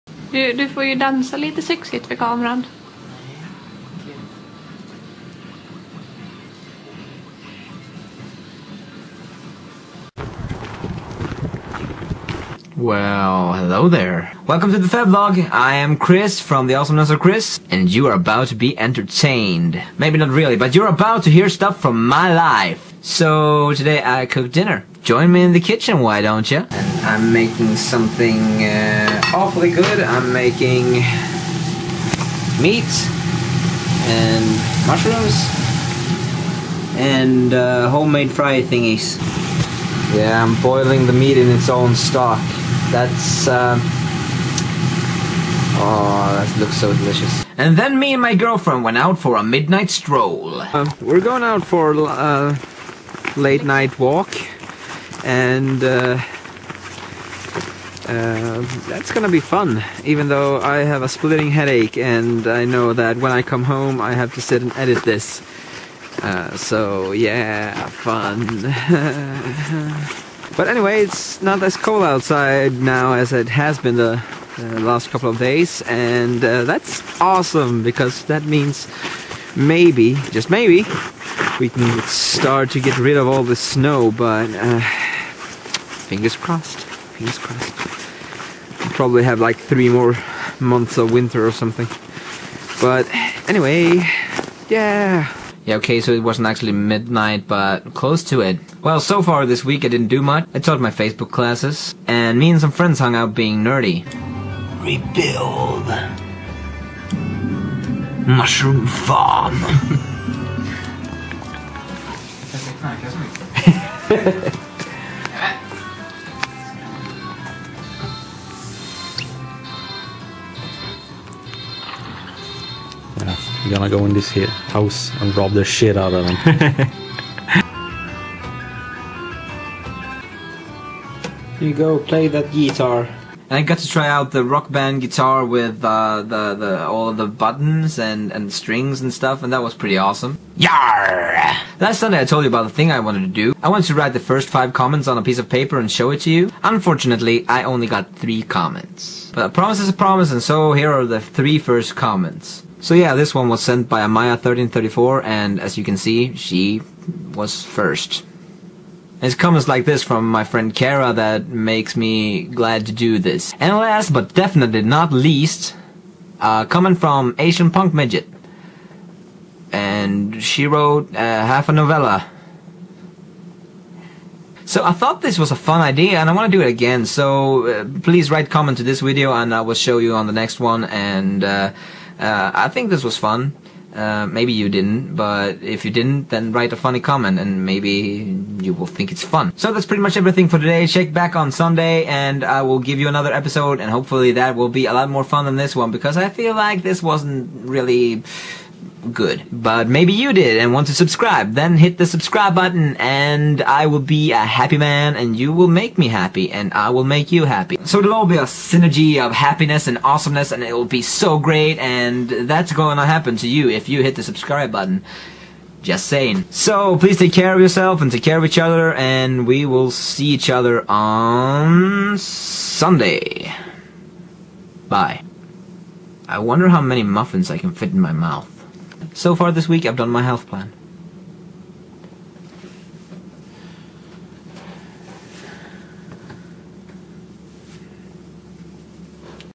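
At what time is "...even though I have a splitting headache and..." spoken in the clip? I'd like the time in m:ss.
1:00.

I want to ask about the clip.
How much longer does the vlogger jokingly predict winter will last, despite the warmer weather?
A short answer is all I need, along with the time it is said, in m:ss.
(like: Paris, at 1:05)
3 months, at 1:29.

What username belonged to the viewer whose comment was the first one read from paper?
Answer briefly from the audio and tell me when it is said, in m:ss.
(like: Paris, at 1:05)
Amaya1334, at 2:34.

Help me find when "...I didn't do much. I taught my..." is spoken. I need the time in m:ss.
1:39.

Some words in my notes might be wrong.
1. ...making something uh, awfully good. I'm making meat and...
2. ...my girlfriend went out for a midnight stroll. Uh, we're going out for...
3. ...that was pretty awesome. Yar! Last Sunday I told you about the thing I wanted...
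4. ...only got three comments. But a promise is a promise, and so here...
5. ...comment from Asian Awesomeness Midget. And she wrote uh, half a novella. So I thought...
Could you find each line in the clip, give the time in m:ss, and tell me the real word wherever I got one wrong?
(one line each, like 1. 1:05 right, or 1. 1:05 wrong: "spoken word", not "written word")
1. 0:27 right
2. 0:48 right
3. 2:19 right
4. 2:27 right
5. 2:46 wrong: "Punk", not "Awesomeness".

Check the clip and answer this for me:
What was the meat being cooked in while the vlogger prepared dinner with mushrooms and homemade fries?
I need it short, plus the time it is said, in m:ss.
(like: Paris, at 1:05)
Its own stock, at 0:41.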